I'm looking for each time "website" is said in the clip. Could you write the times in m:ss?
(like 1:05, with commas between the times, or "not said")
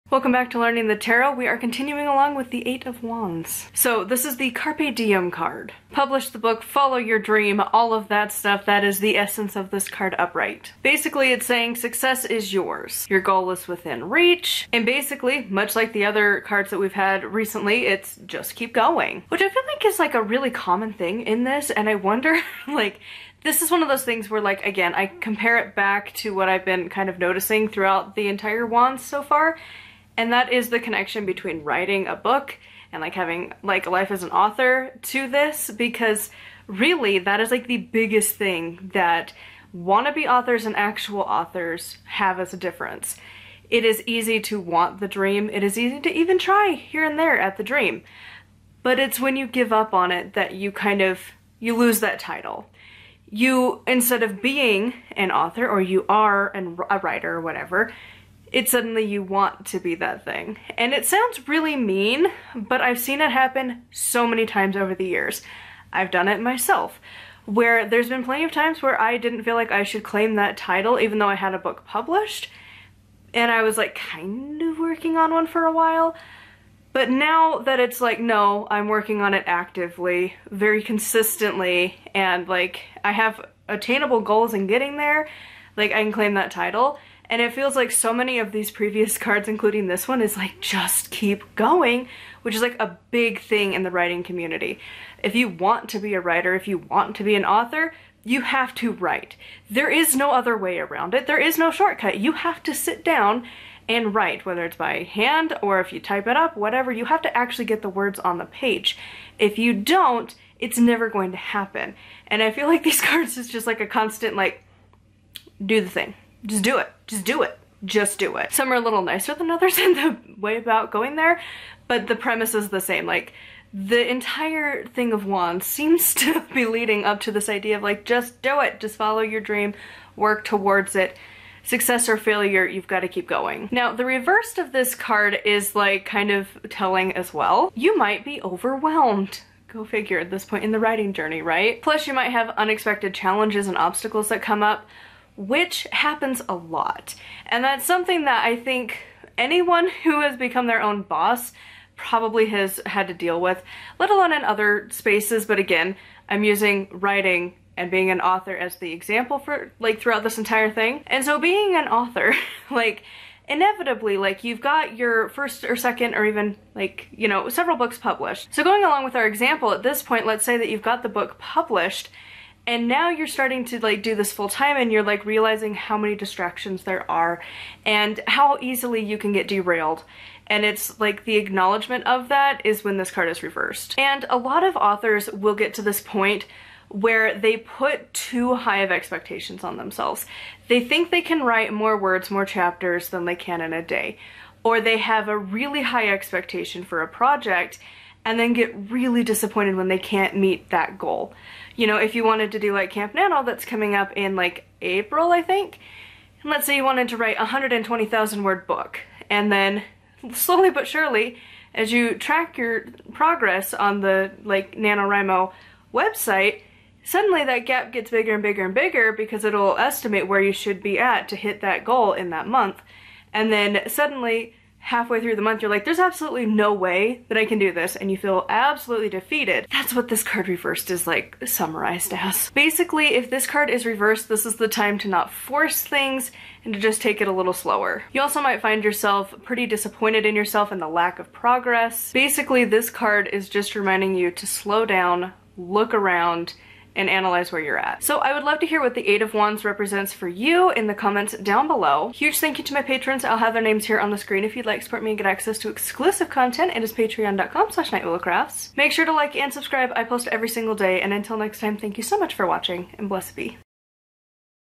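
3:35.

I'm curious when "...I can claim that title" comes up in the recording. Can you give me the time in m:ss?
1:25.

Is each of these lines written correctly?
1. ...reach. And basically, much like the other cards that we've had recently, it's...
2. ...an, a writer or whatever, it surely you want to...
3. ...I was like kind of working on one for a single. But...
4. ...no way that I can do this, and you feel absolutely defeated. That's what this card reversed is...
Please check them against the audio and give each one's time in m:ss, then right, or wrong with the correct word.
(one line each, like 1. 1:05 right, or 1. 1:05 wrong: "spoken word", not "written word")
1. 0:14 right
2. 0:56 wrong: "suddenly", not "surely"
3. 1:13 wrong: "while", not "single"
4. 3:46 right.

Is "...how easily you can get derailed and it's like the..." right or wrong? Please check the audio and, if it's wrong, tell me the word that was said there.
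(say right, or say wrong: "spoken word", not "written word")
right.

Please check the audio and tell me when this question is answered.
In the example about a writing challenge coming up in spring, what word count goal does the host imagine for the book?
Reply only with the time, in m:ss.
3:27.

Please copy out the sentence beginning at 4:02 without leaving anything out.
Basically, this card is just reminding you to slow down, look around, and analyze where you're at.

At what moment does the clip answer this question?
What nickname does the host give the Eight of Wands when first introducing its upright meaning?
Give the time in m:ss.
0:04.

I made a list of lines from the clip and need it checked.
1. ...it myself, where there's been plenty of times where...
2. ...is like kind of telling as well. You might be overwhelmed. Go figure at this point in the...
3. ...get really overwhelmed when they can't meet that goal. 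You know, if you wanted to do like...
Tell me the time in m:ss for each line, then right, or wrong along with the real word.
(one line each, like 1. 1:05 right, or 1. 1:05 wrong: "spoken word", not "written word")
1. 1:06 right
2. 2:15 right
3. 3:18 wrong: "disappointed", not "overwhelmed".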